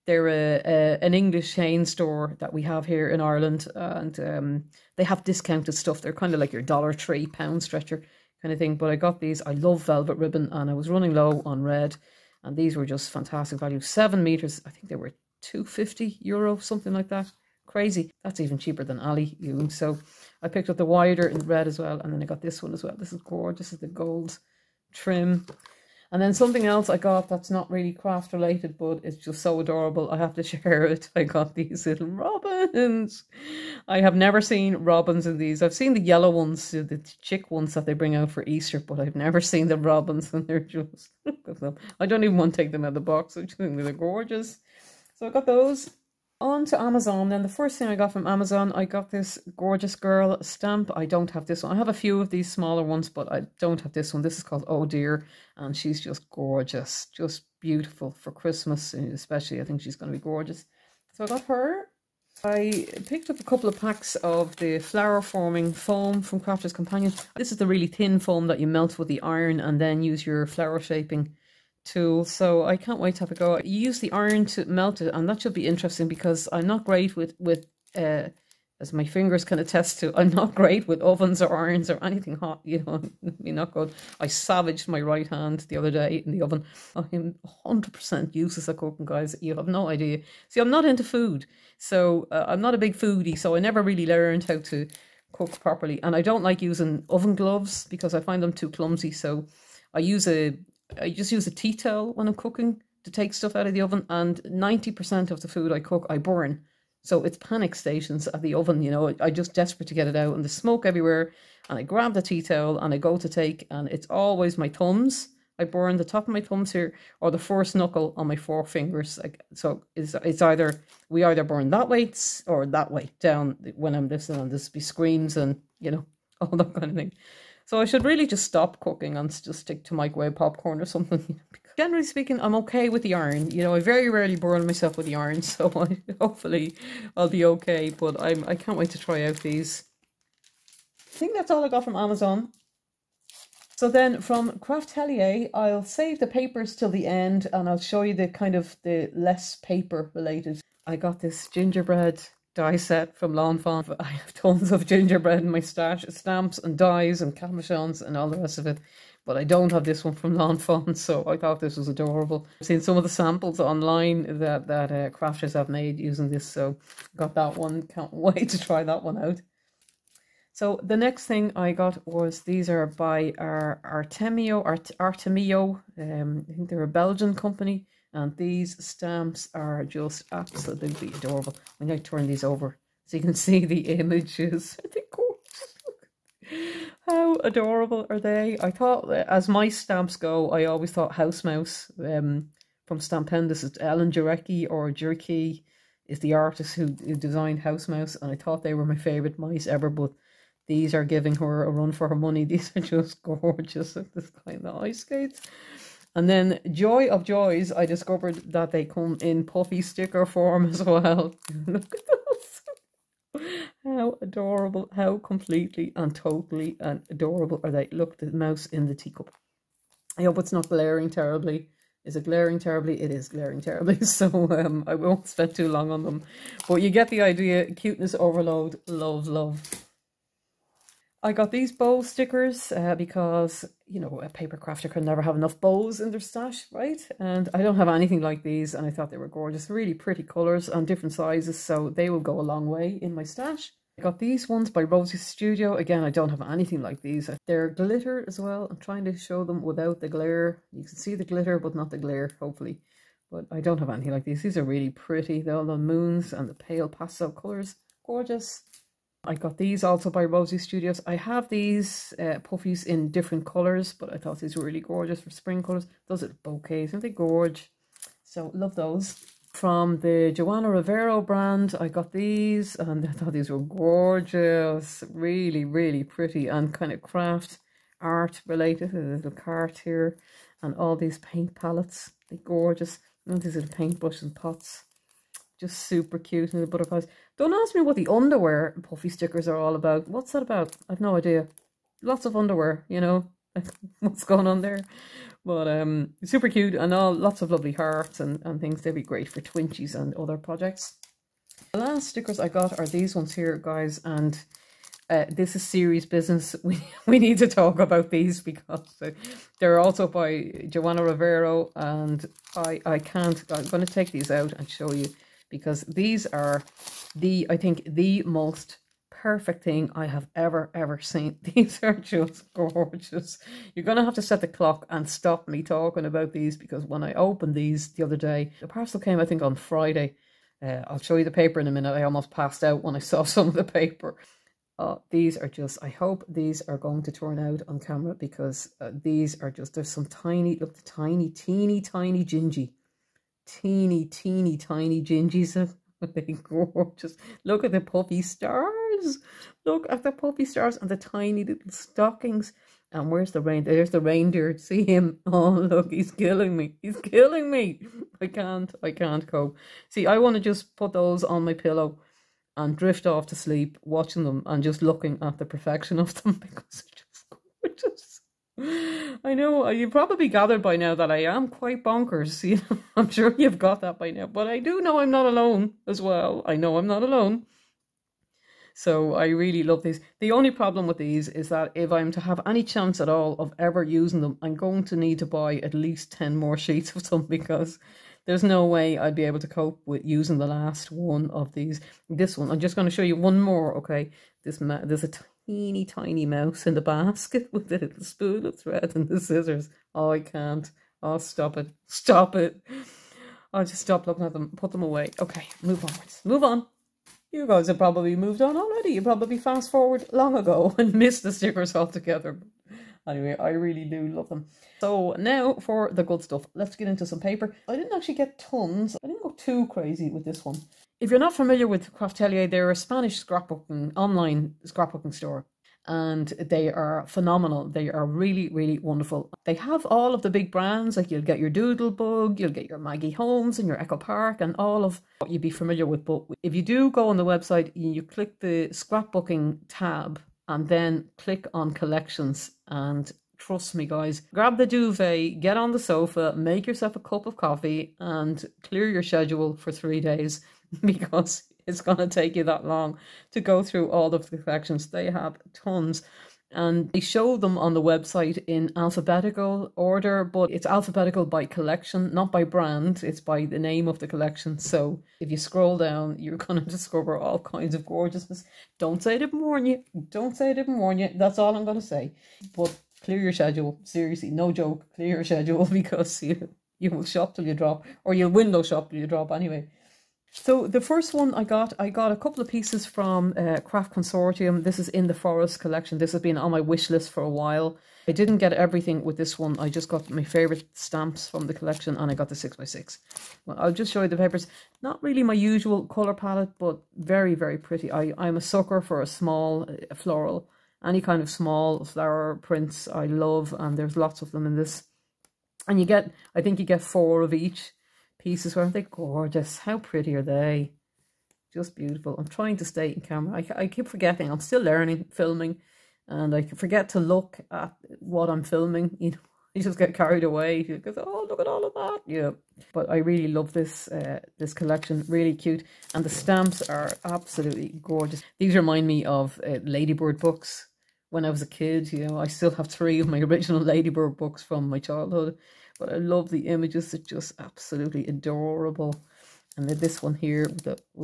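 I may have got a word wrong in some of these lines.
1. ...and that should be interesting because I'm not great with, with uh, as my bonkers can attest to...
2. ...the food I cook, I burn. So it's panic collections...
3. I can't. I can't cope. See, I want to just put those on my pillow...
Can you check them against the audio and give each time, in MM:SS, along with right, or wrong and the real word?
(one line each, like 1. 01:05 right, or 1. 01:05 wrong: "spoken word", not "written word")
1. 01:15 wrong: "fingers", not "bonkers"
2. 01:45 wrong: "stations", not "collections"
3. 05:58 right.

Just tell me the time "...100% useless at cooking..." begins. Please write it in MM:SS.
01:27.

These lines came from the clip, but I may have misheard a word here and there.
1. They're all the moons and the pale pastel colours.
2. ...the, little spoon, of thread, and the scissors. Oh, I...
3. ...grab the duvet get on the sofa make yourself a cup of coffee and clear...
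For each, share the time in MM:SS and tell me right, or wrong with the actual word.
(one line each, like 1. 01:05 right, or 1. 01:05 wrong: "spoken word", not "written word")
1. 04:15 right
2. 06:37 right
3. 07:24 right.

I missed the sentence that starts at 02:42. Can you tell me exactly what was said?
I've seen some of the samples online that, that uh, crafters have made using this, so got that one.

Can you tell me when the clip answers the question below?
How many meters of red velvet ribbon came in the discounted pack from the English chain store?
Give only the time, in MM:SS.
00:13.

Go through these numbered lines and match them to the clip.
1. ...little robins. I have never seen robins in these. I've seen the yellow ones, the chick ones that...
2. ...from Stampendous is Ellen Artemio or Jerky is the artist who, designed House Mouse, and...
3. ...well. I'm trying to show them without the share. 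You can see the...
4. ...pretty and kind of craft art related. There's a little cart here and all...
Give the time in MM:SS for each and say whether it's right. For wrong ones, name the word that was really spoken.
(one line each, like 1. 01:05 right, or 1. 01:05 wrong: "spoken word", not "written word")
1. 00:31 right
2. 03:12 wrong: "Jareckie", not "Artemio"
3. 04:08 wrong: "glare", not "share"
4. 04:36 right.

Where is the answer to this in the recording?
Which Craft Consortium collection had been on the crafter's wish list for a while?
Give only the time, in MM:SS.
08:05.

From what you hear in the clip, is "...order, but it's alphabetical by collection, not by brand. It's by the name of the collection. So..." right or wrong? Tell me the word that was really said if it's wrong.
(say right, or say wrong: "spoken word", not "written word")
right.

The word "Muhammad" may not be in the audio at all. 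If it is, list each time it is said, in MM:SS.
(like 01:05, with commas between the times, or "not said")
not said.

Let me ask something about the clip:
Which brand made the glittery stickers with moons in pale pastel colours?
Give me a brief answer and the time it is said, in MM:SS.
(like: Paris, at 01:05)
Rosie Studio, at 04:04.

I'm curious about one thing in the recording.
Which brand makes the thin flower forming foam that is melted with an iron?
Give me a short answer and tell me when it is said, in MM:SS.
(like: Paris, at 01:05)
Crafter's Companion, at 01:06.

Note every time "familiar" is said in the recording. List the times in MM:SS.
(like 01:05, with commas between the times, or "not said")
07:01, 07:15.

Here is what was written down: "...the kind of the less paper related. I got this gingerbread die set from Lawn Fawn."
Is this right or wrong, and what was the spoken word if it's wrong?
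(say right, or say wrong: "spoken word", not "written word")
right.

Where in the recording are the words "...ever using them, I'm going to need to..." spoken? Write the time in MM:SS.
06:23.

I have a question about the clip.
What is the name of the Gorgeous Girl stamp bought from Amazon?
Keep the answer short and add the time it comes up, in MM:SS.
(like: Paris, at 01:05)
Oh Dear, at 00:54.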